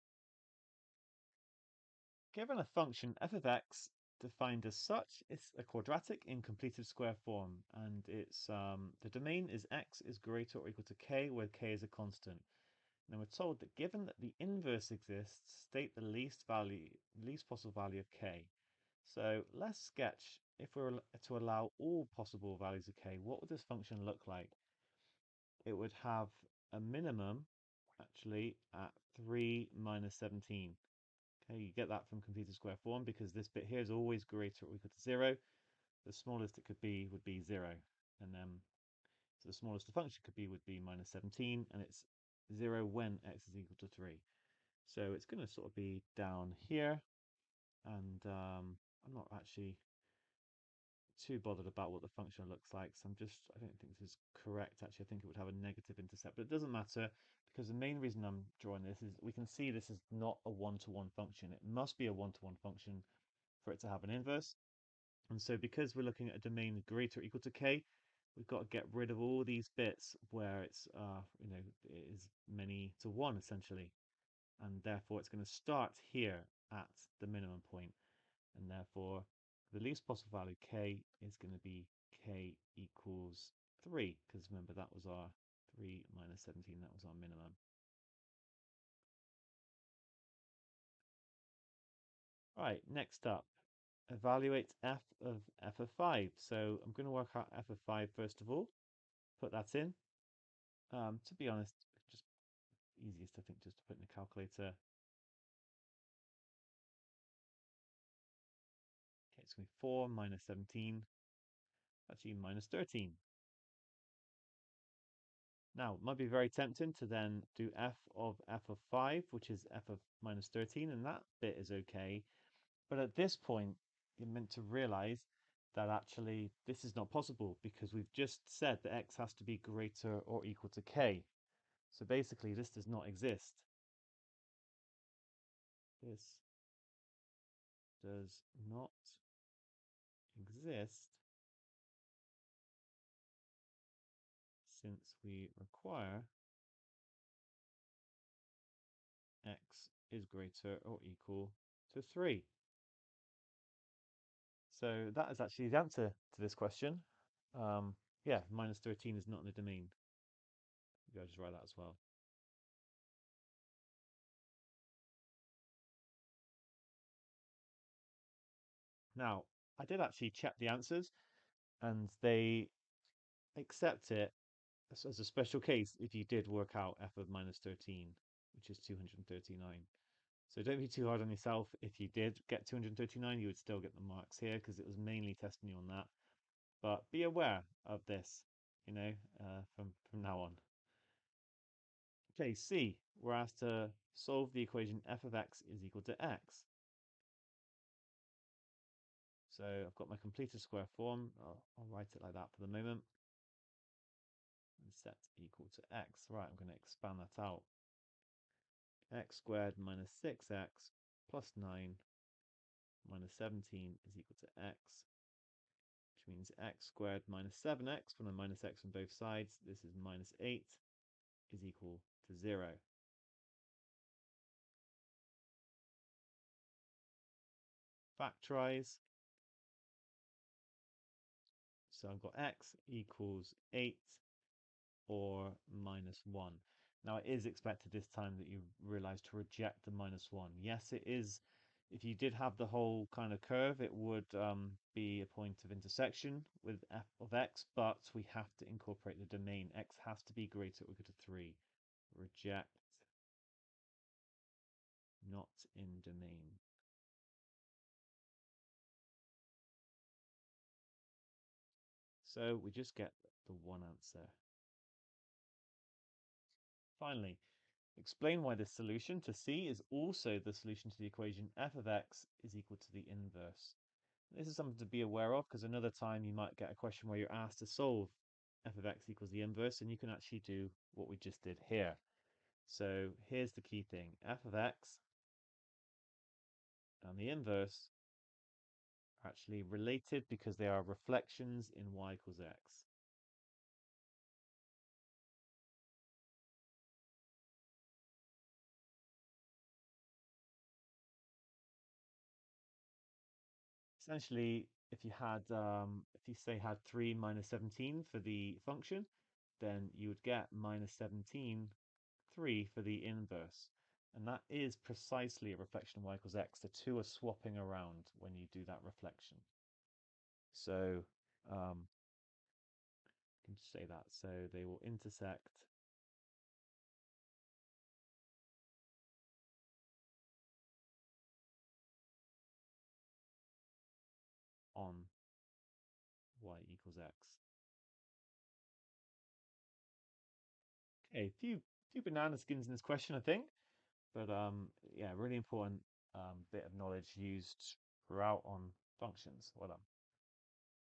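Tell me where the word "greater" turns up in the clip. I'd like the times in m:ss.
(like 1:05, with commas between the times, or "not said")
0:10, 0:34, 1:06, 2:09, 2:30, 4:10.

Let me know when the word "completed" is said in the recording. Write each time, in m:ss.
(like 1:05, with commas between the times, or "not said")
0:06, 0:32, 3:20.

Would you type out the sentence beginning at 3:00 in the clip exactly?
So don't be too hard on yourself.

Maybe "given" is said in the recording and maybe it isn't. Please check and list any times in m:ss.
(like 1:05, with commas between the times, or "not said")
0:02, 0:13.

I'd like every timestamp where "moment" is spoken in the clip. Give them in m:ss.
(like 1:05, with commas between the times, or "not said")
3:22.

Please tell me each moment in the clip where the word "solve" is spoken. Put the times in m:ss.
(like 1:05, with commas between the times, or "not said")
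3:14, 4:37.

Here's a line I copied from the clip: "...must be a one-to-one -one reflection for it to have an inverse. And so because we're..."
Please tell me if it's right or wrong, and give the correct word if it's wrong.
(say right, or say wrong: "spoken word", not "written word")
wrong: "function", not "reflection".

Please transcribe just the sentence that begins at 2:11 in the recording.
So basically, this does not exist.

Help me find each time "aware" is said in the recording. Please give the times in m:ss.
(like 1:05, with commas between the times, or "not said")
3:07, 4:35.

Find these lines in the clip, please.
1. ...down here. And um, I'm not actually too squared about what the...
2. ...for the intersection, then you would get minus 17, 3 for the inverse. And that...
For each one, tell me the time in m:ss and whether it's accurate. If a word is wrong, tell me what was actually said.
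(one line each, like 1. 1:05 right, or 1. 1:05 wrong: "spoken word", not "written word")
1. 0:46 wrong: "bothered", not "squared"
2. 5:08 wrong: "function", not "intersection".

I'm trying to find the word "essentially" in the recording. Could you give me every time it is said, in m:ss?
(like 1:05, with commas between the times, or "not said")
1:13, 5:04.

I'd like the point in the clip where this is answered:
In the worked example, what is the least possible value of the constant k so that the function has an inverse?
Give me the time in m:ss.
1:22.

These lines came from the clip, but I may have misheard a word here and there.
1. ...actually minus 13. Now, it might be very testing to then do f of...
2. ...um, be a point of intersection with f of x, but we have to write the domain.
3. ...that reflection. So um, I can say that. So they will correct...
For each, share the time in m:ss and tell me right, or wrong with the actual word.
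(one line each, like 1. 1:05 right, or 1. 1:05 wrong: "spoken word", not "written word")
1. 1:52 wrong: "tempting", not "testing"
2. 4:04 wrong: "incorporate", not "write"
3. 5:18 wrong: "intersect", not "correct".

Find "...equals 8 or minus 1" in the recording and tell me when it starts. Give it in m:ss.
3:52.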